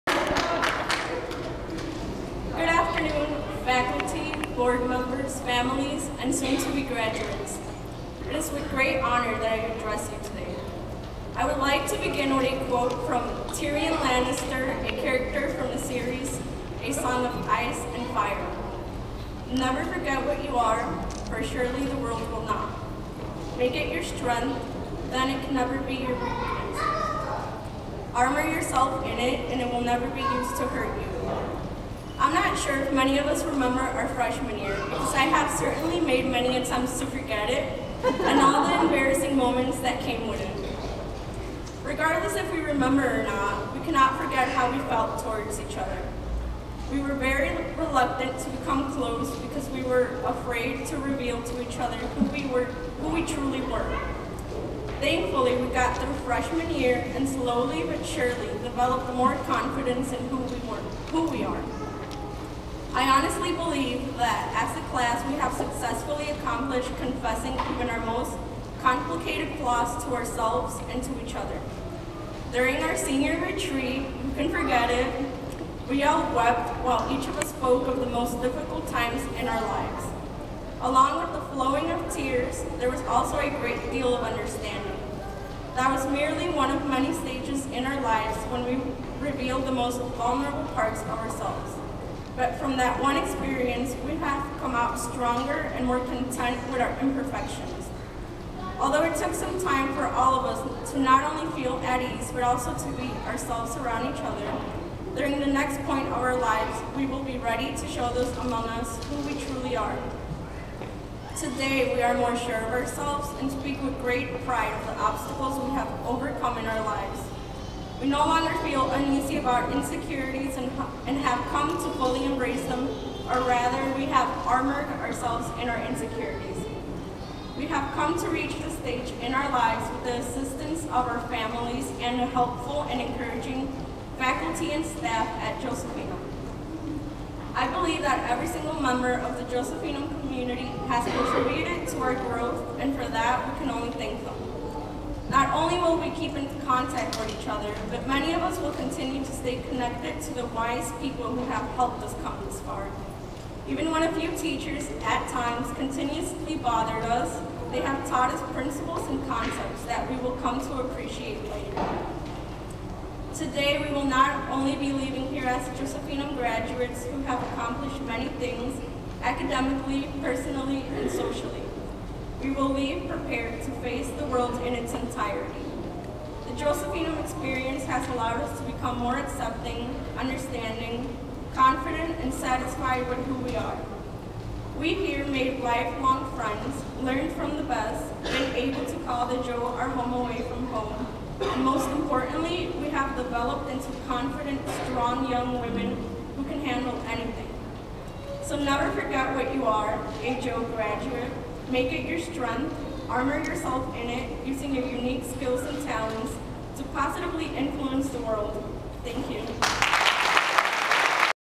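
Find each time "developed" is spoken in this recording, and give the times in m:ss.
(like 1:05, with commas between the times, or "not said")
0:58, 3:13.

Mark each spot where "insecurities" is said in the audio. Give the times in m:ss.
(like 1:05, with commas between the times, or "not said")
1:59, 2:05.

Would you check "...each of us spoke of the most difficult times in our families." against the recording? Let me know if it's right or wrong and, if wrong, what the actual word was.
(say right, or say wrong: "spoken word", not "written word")
wrong: "lives", not "families".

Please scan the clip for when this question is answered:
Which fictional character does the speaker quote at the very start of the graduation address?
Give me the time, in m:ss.
0:13.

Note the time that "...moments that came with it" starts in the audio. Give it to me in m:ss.
0:39.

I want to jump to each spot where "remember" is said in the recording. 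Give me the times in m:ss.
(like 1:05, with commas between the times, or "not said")
0:33, 0:42.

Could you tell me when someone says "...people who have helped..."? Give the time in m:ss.
2:31.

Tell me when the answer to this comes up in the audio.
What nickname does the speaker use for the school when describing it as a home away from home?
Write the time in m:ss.
3:09.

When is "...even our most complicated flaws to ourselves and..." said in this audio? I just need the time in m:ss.
1:07.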